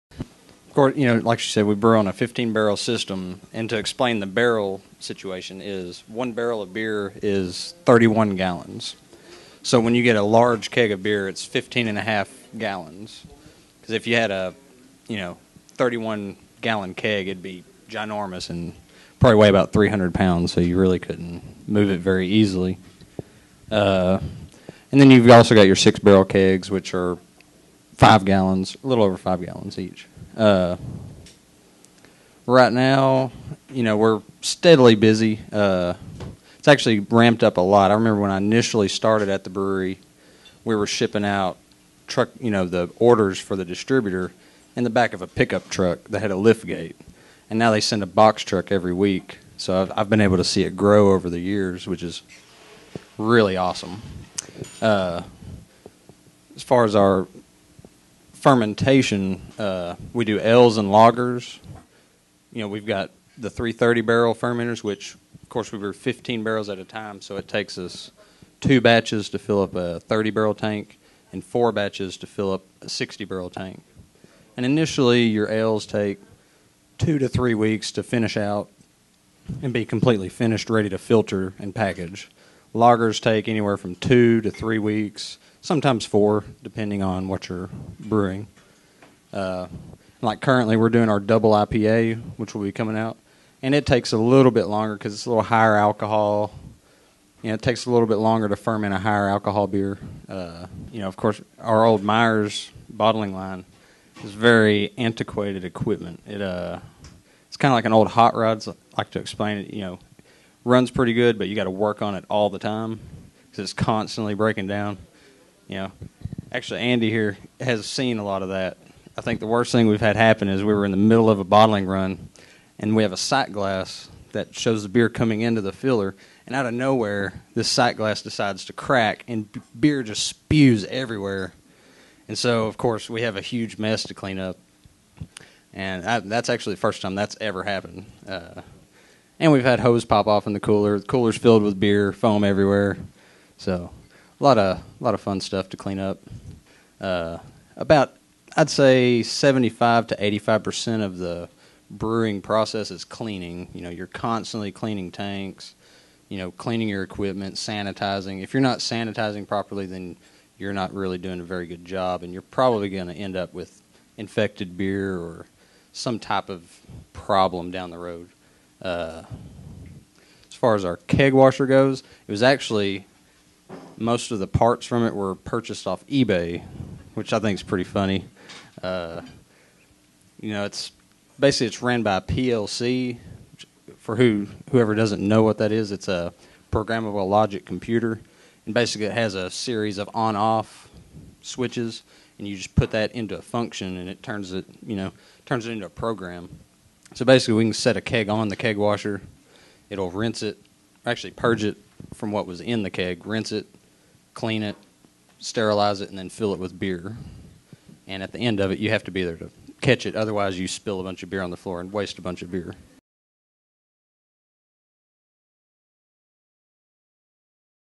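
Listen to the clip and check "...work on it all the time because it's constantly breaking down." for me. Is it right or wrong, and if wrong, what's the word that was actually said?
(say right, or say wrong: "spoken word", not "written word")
right.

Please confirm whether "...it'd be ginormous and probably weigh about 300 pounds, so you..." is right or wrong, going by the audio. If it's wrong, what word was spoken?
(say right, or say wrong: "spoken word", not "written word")
right.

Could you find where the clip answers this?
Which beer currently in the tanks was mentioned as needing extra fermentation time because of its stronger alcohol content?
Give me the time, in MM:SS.
01:31.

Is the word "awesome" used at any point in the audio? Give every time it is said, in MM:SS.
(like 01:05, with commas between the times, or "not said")
00:53.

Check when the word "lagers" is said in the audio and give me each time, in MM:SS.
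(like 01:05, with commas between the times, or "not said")
01:00, 01:22.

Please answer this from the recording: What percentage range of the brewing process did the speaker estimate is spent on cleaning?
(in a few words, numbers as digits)
75 to 85 percent.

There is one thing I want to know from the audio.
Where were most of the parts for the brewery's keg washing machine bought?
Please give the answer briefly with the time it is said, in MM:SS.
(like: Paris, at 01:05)
eBay, at 02:56.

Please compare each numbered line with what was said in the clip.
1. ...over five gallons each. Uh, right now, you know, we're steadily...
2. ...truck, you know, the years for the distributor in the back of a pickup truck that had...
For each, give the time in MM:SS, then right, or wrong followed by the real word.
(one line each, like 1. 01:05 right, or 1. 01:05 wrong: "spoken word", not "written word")
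1. 00:29 right
2. 00:42 wrong: "orders", not "years".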